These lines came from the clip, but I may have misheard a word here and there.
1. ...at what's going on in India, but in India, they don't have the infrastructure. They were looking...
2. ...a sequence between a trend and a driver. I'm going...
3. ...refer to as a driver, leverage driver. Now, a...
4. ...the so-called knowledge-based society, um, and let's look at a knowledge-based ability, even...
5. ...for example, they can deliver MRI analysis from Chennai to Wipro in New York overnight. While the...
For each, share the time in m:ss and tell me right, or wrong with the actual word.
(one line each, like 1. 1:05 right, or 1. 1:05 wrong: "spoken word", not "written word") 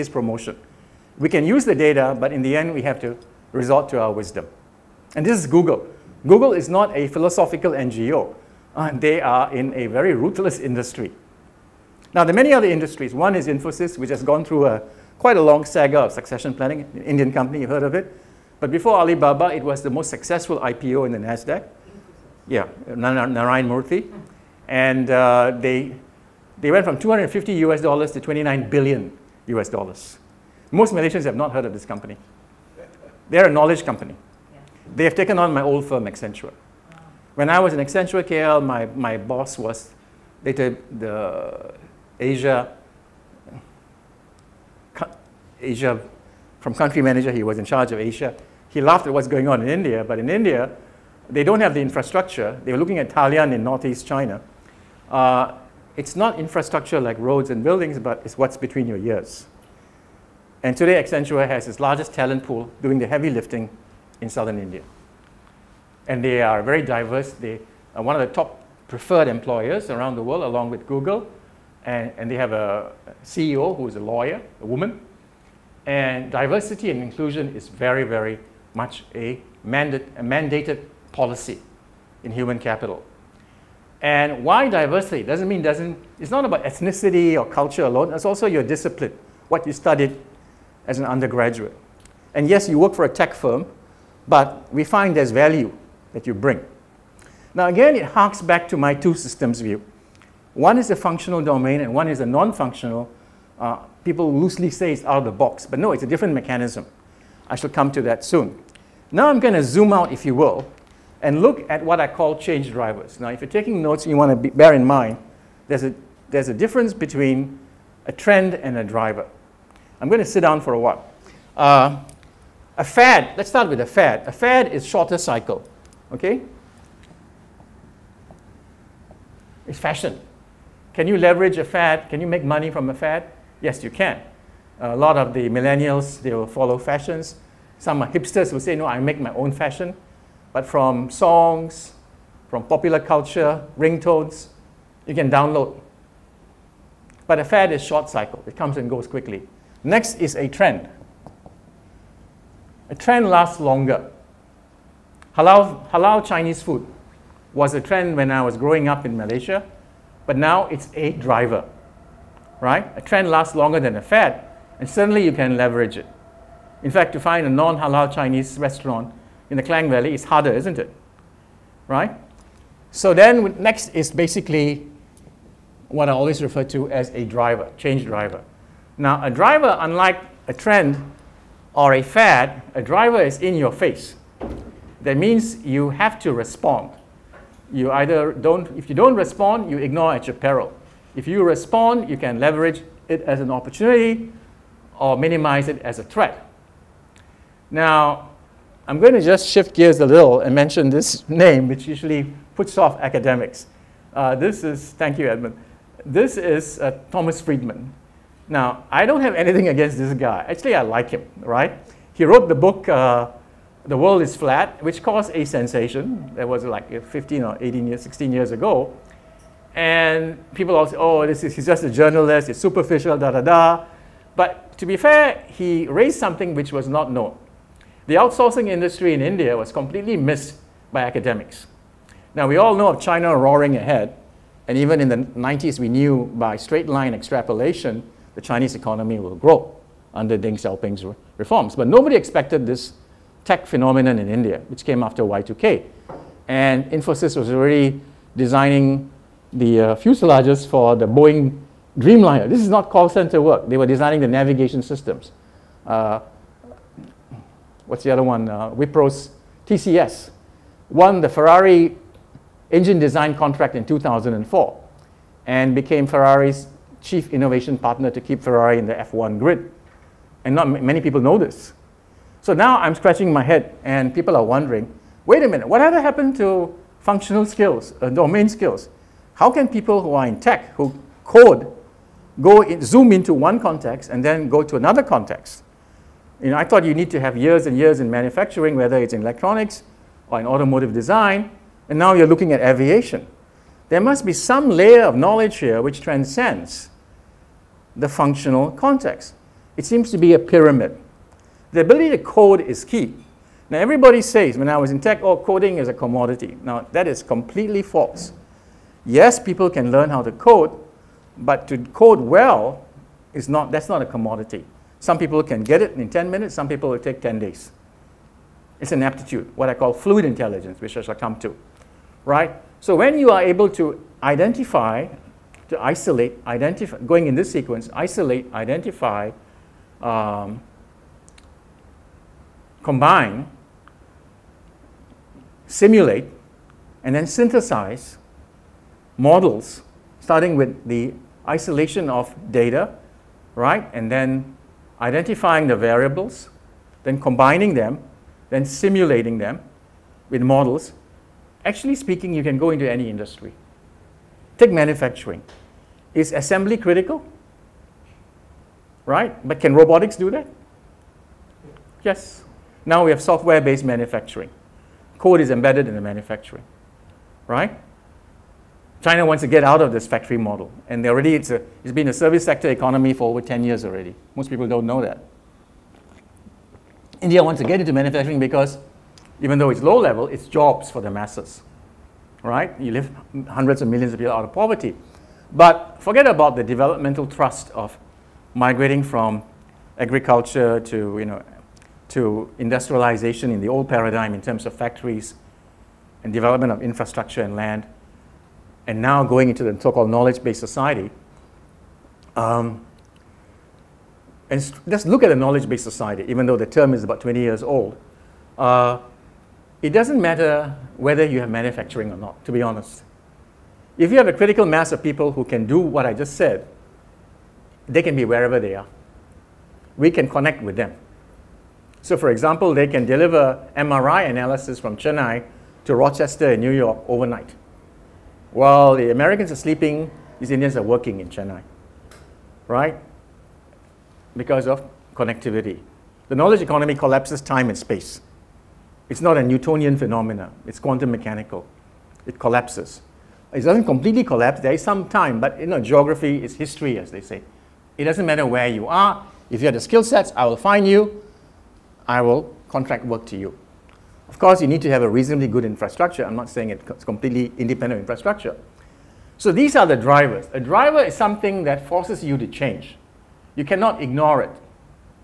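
1. 0:49 right
2. 1:56 wrong: "difference", not "sequence"
3. 2:56 wrong: "change", not "leverage"
4. 6:39 wrong: "society", not "ability"
5. 7:02 wrong: "Rochester", not "Wipro".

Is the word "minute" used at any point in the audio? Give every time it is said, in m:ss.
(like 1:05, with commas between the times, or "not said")
4:35, 5:16.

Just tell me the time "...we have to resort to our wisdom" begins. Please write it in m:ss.
0:02.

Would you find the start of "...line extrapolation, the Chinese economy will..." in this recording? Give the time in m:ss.
3:56.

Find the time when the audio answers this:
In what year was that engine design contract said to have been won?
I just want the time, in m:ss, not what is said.
4:23.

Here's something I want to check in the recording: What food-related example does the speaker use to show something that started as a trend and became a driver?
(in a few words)
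Halal Chinese food.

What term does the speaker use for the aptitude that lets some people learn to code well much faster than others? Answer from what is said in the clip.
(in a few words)
Fluid intelligence.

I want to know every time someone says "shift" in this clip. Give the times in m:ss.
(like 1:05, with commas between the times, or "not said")
3:19.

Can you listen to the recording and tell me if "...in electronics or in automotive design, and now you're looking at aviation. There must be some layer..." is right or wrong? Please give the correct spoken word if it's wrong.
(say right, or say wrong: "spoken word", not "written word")
right.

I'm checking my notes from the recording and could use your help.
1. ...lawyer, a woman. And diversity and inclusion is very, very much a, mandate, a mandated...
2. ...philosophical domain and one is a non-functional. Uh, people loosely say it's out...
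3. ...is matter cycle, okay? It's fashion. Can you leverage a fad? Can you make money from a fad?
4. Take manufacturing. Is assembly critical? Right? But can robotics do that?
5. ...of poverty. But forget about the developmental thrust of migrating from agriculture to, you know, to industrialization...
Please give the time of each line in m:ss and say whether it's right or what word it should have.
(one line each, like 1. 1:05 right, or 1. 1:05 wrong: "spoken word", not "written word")
1. 1:14 right
2. 1:40 wrong: "functional", not "philosophical"
3. 2:04 wrong: "shorter", not "matter"
4. 5:54 right
5. 6:24 right.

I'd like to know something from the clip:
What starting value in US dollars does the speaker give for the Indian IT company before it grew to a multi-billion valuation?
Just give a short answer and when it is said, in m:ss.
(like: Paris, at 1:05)
$250, at 0:26.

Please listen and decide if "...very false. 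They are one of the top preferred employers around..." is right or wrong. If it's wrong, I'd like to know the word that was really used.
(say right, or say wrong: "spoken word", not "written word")
wrong: "diverse", not "false".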